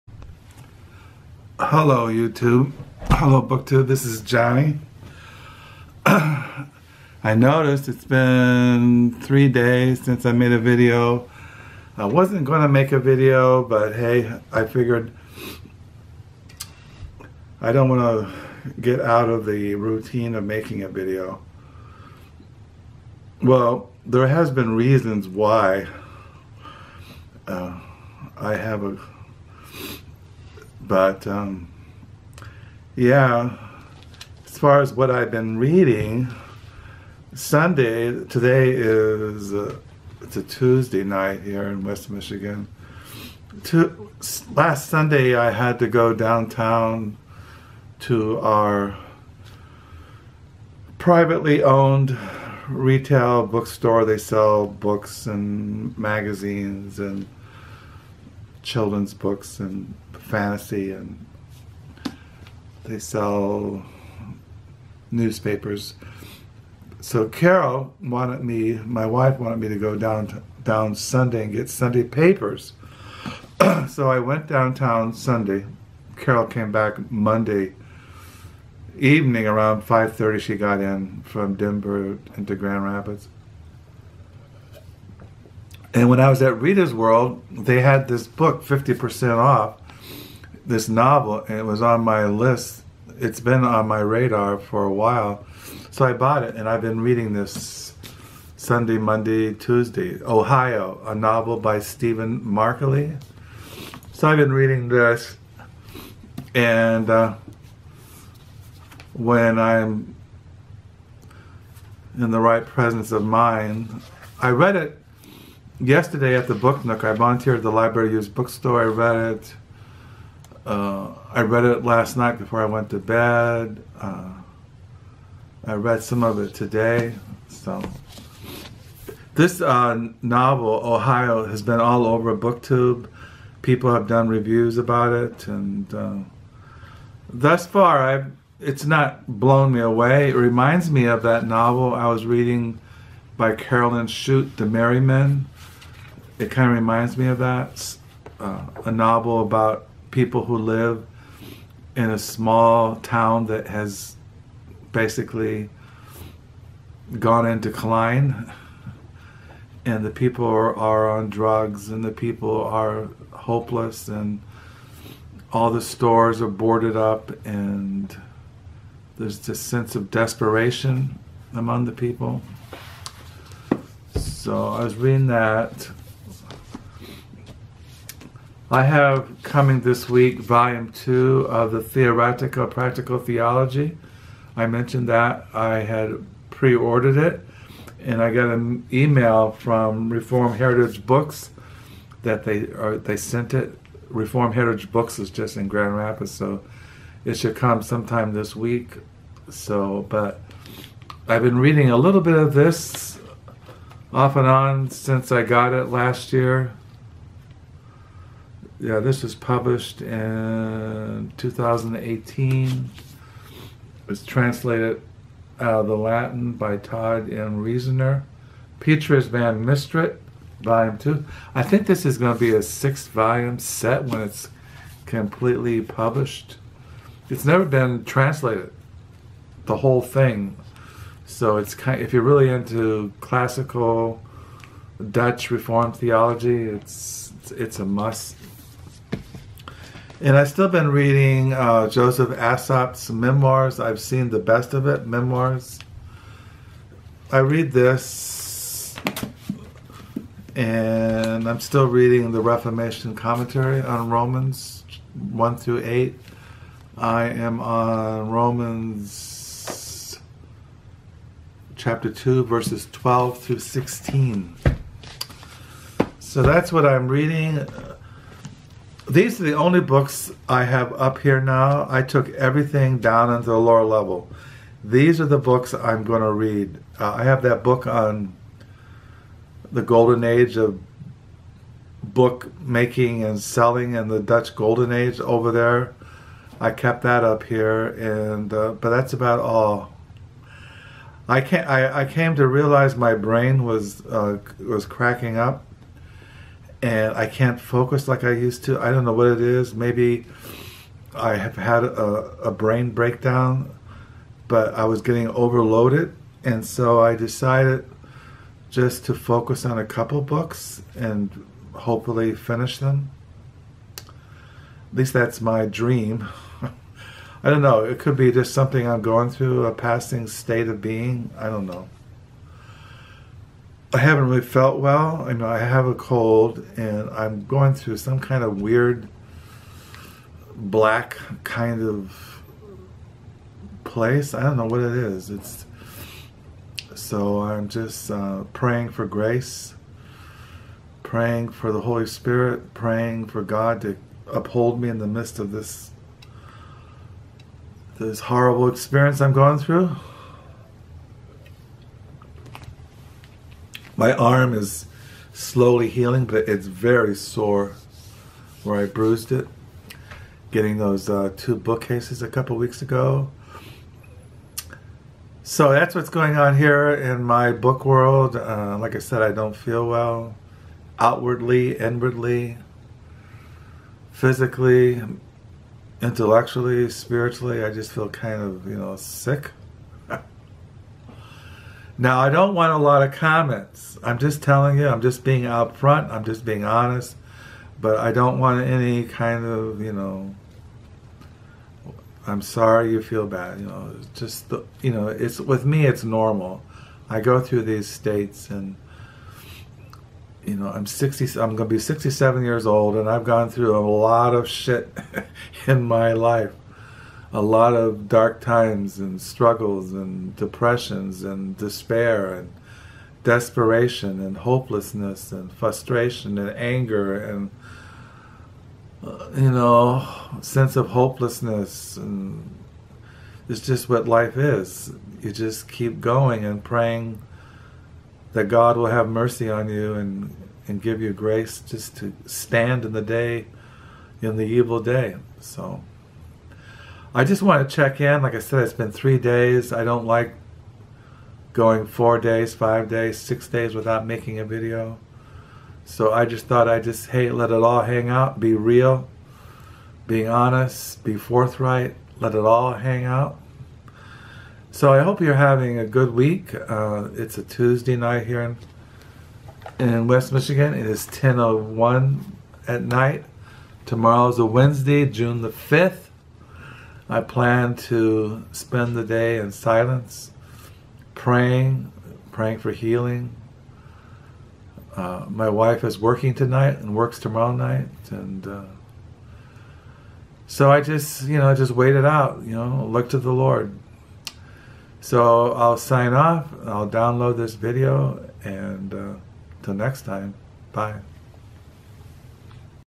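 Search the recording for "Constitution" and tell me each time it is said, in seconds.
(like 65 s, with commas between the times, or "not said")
not said.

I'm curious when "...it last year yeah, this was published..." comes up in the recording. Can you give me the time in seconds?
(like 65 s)
205 s.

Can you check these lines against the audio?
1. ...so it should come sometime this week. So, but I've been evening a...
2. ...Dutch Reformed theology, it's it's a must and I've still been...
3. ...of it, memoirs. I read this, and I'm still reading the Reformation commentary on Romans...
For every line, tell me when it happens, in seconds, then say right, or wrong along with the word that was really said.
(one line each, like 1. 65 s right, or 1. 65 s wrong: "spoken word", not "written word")
1. 196 s wrong: "reading", not "evening"
2. 235 s right
3. 244 s right.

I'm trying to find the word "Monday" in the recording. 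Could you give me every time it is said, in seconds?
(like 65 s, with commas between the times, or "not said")
77 s, 98 s.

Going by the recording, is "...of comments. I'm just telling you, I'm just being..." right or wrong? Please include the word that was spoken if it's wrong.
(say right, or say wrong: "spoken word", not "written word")
right.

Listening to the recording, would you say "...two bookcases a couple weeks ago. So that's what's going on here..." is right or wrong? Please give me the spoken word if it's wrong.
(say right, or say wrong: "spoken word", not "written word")
right.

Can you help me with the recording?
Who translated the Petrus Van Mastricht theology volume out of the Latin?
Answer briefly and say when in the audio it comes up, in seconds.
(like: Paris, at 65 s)
Todd M. Rester, at 216 s.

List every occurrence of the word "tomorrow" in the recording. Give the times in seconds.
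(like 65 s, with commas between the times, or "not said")
463 s, 477 s.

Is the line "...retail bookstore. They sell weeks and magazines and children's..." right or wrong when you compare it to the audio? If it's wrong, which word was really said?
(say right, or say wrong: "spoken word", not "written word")
wrong: "books", not "weeks".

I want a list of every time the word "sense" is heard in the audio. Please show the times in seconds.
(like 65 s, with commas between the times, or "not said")
169 s, 420 s.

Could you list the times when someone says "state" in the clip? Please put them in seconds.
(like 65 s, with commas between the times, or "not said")
320 s, 397 s.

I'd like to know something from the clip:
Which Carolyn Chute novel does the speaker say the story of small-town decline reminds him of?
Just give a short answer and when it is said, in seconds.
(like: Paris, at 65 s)
The Men, at 144 s.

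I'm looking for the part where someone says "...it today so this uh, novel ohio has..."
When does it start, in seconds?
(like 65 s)
126 s.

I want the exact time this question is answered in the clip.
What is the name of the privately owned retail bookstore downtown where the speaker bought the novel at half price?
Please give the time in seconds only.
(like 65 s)
86 s.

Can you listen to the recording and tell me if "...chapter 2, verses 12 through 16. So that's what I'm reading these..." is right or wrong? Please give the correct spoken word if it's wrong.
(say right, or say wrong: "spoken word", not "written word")
right.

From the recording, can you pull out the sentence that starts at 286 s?
I kept that up here, and uh, but that's about all.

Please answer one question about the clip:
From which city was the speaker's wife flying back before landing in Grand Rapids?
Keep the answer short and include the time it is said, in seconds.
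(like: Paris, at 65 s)
Denver, at 81 s.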